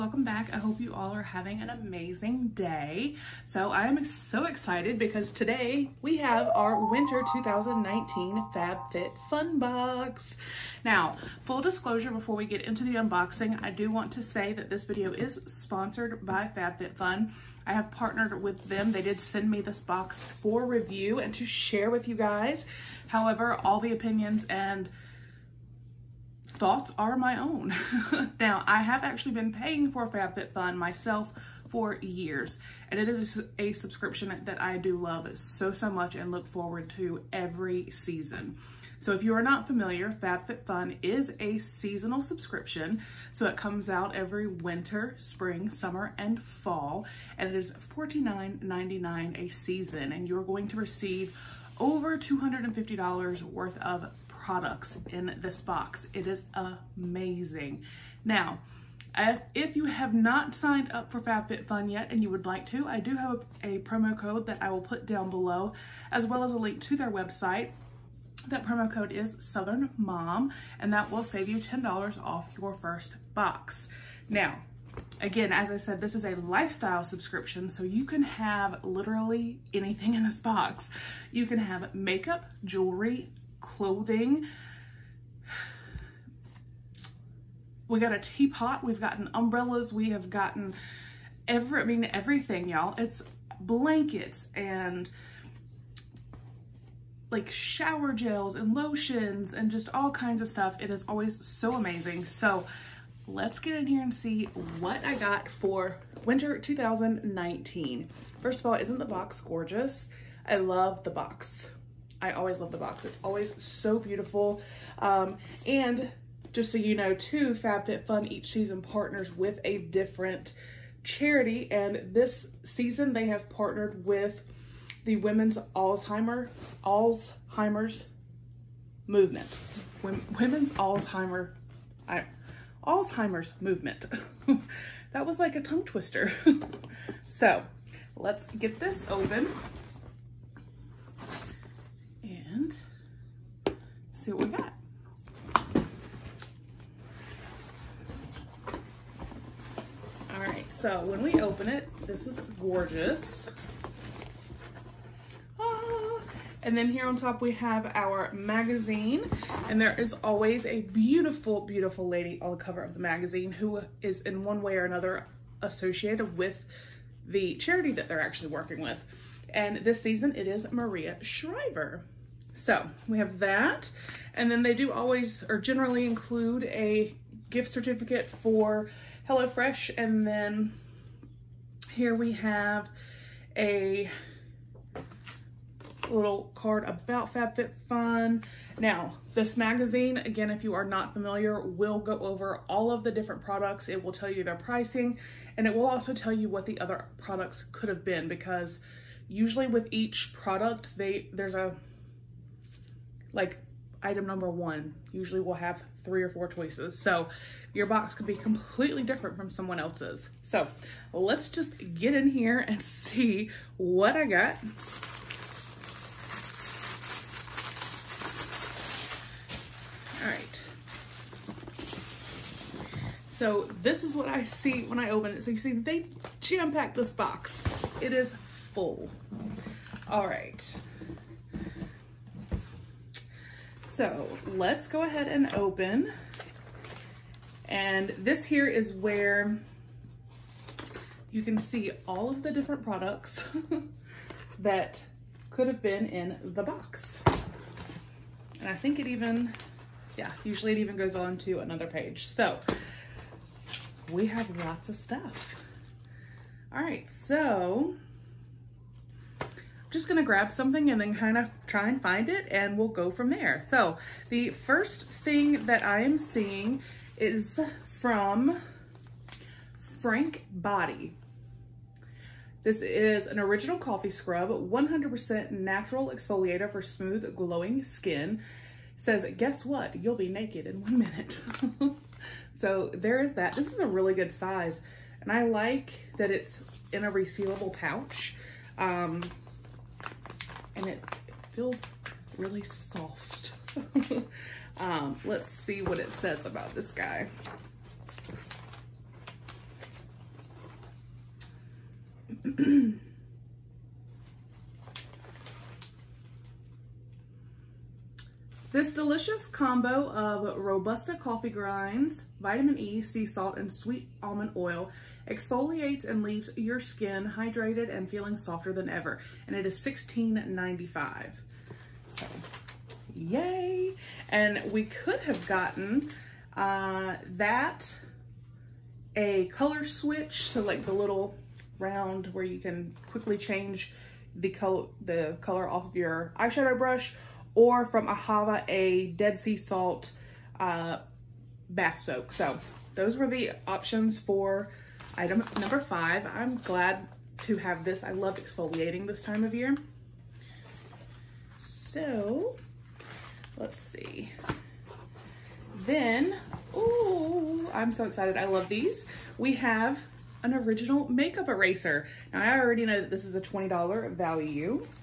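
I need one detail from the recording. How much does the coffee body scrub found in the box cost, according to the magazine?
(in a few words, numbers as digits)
$16.95.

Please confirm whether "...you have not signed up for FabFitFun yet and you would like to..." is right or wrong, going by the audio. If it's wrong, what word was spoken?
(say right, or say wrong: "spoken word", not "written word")
right.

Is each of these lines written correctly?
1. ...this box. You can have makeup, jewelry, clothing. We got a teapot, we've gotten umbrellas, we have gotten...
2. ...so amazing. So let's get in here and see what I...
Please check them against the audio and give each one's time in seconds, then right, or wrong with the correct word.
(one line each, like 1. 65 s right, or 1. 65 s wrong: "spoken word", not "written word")
1. 80 s right
2. 101 s right.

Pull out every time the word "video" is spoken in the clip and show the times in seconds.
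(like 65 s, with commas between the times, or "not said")
14 s.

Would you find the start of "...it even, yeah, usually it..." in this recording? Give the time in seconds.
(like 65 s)
248 s.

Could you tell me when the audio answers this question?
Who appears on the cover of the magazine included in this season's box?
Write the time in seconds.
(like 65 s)
170 s.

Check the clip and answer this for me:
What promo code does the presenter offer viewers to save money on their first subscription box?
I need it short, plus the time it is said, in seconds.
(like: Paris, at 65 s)
Southern Mom, at 69 s.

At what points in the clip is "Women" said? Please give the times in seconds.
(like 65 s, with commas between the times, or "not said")
125 s, 130 s.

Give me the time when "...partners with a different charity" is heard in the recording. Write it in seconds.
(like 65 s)
118 s.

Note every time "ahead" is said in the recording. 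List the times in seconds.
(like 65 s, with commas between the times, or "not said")
235 s.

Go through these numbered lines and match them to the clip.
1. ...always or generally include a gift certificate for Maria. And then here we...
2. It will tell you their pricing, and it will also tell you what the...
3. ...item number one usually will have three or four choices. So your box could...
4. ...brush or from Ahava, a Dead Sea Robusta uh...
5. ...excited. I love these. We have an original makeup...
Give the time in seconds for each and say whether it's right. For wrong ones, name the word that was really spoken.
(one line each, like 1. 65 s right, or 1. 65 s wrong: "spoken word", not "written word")
1. 174 s wrong: "HelloFresh", not "Maria"
2. 193 s right
3. 204 s right
4. 336 s wrong: "Salt", not "Robusta"
5. 358 s right.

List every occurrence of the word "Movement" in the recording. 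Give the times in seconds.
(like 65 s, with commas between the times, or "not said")
129 s, 133 s.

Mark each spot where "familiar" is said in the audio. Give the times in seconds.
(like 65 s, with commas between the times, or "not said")
39 s, 191 s.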